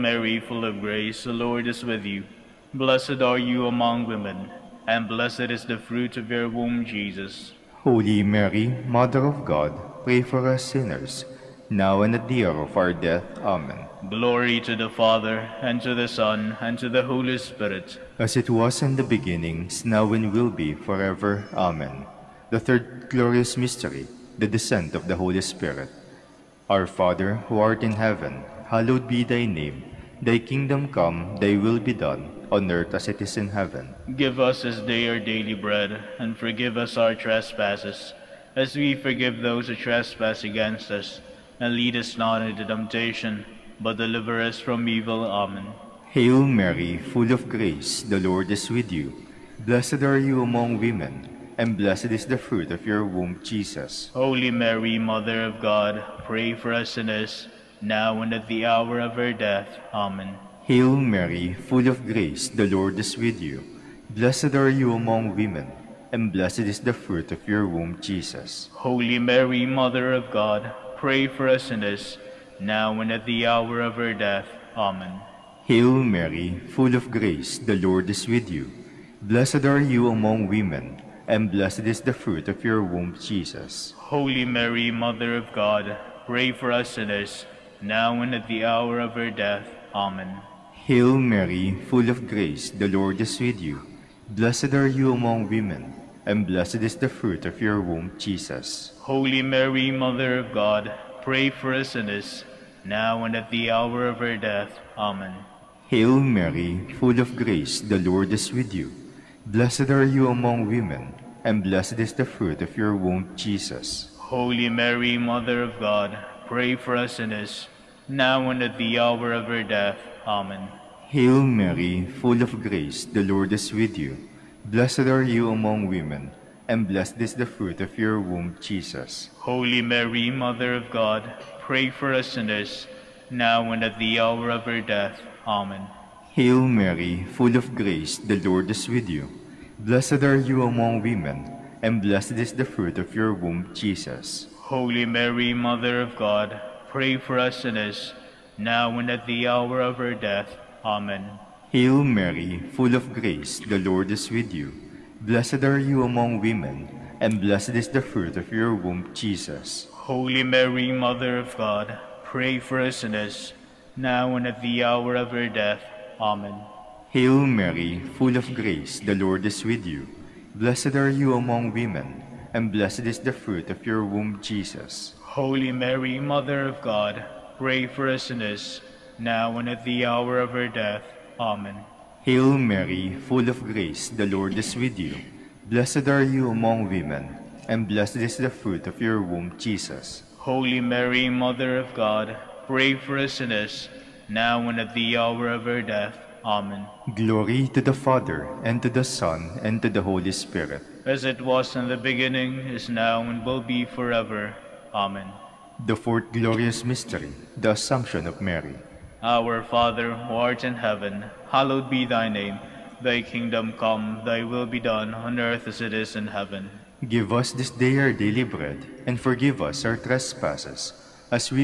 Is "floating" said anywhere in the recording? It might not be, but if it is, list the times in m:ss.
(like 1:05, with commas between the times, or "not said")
not said.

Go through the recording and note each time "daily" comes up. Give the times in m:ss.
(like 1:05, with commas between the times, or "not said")
0:35, 3:38.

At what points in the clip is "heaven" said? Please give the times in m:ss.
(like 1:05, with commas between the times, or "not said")
0:27, 0:33, 3:30, 3:36.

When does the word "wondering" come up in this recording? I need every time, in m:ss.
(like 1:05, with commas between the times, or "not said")
not said.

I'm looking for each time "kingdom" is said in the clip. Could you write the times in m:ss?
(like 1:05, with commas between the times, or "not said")
0:30, 3:33.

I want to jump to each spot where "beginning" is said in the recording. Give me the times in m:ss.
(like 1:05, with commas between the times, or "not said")
0:19, 3:21.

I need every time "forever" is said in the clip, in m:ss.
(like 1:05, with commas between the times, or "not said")
0:20, 3:23.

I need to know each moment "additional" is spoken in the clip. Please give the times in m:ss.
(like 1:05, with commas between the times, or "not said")
not said.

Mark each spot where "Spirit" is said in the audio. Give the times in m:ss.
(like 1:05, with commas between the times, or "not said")
0:17, 0:25, 3:20.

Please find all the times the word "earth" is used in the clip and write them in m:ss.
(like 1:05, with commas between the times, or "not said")
0:32, 3:35.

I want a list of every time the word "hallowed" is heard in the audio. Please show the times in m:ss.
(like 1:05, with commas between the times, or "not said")
0:28, 3:31.